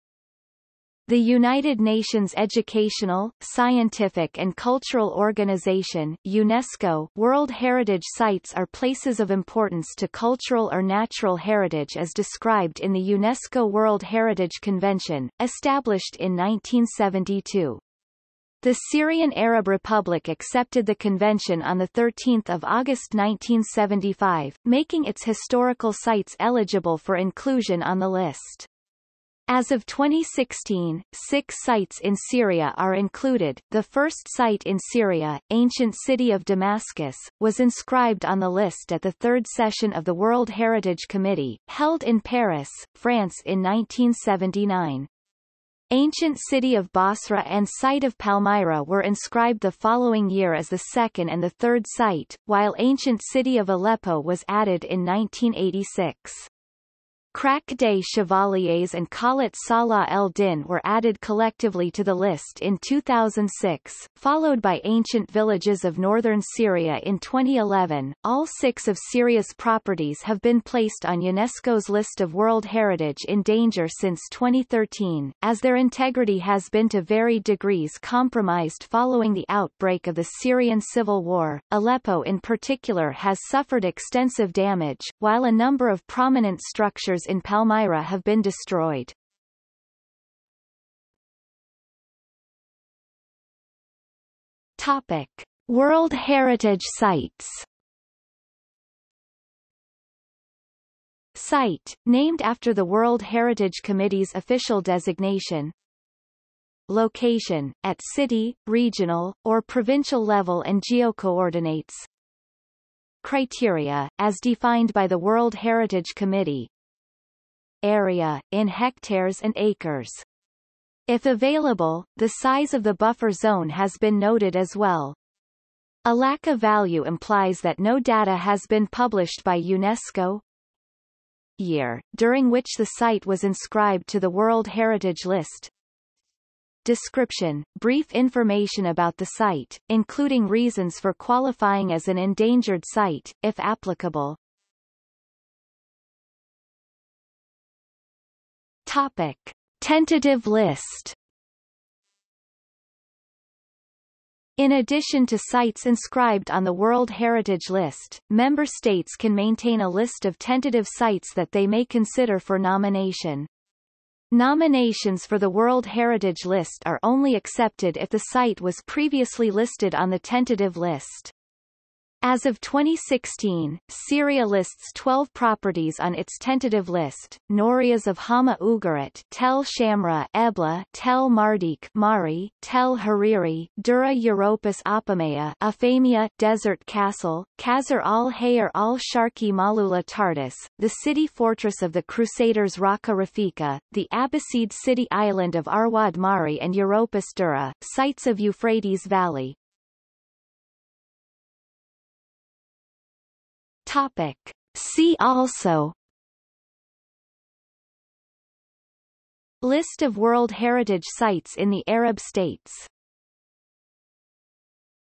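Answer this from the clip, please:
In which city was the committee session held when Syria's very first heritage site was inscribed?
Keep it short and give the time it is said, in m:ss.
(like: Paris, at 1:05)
Paris, at 0:42.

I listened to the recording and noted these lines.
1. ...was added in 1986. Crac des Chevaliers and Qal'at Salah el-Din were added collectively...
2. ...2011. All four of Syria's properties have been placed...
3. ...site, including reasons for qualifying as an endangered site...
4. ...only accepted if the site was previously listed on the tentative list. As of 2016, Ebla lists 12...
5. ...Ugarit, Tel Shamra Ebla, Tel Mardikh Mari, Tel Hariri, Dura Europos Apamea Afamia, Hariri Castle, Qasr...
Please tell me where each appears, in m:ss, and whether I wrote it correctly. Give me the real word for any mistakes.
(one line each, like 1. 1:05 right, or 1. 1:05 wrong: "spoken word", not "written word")
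1. 0:54 right
2. 1:07 wrong: "six", not "four"
3. 2:19 right
4. 2:47 wrong: "Syria", not "Ebla"
5. 2:58 wrong: "Desert", not "Hariri".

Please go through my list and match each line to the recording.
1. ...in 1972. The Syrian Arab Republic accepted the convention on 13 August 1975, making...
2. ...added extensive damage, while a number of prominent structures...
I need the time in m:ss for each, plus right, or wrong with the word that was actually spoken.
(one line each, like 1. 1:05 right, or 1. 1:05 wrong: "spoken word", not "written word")
1. 0:16 right
2. 1:23 wrong: "suffered", not "added".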